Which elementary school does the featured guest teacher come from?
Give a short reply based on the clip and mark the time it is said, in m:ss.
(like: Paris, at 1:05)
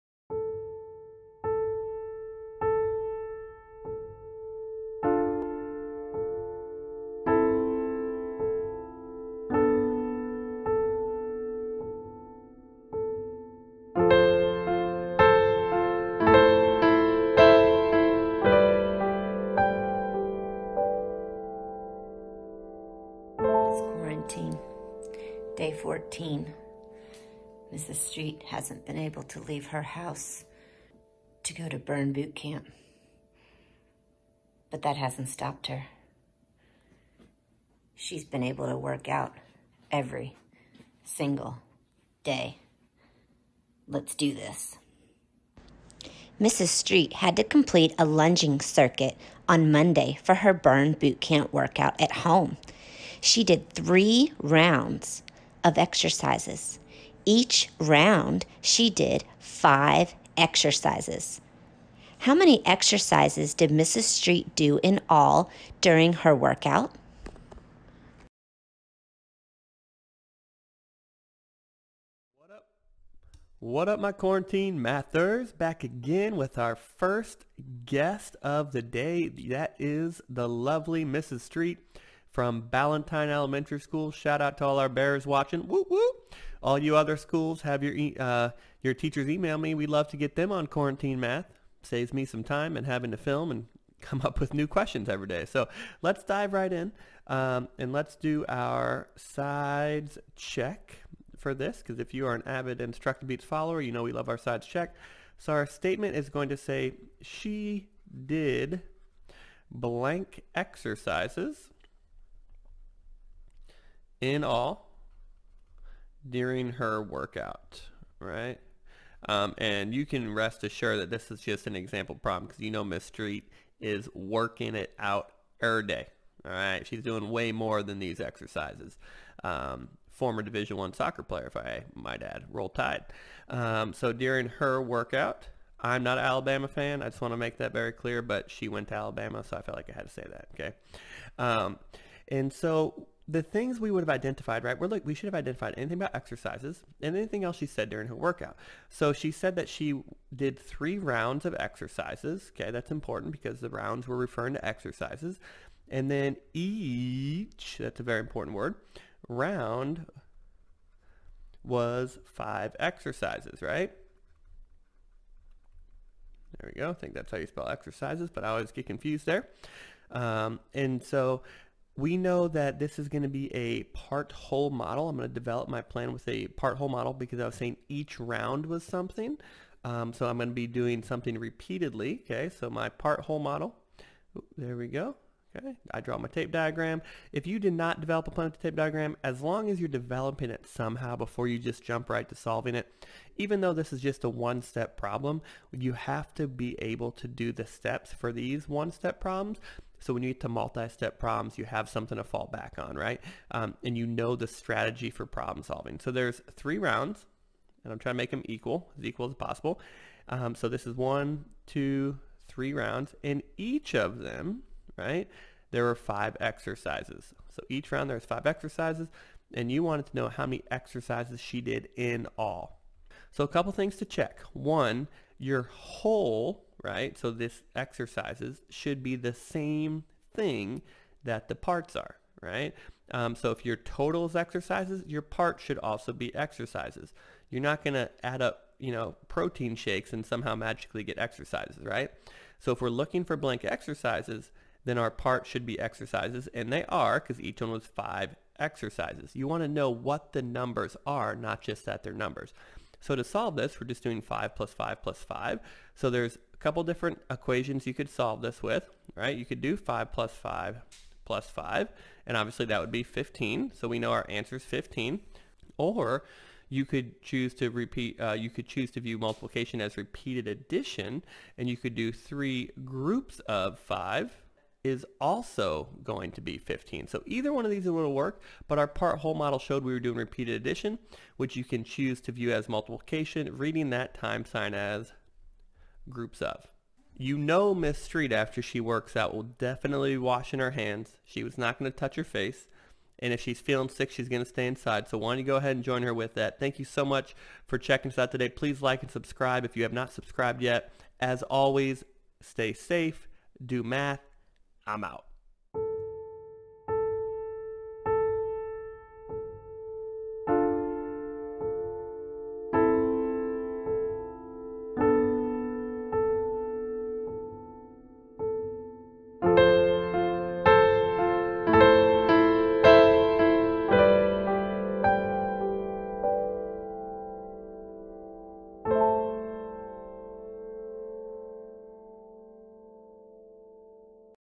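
Ballantine Elementary School, at 1:22.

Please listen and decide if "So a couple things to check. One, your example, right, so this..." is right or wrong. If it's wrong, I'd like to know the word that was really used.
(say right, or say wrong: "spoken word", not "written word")
wrong: "whole", not "example".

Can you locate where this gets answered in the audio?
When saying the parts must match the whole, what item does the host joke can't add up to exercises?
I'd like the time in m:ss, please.
3:59.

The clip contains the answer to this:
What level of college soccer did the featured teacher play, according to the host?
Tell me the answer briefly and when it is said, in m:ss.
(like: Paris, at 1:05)
Division One, at 2:10.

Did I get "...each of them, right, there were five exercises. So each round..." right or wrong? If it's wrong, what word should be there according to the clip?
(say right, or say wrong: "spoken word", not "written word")
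right.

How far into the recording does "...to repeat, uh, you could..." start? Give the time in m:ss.
4:27.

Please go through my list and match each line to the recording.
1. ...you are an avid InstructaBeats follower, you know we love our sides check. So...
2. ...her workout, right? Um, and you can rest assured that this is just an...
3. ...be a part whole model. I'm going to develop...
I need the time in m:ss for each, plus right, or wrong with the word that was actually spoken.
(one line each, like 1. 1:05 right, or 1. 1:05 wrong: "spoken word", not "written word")
1. 1:42 right
2. 1:56 right
3. 2:53 right.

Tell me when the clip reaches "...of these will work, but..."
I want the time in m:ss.
4:37.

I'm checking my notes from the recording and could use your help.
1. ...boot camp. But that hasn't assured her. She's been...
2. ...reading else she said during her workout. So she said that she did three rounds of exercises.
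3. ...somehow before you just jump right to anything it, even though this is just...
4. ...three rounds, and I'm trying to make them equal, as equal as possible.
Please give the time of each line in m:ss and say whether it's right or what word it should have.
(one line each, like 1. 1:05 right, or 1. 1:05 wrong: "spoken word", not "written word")
1. 0:32 wrong: "stopped", not "assured"
2. 2:27 wrong: "anything", not "reading"
3. 3:10 wrong: "solving", not "anything"
4. 3:26 right.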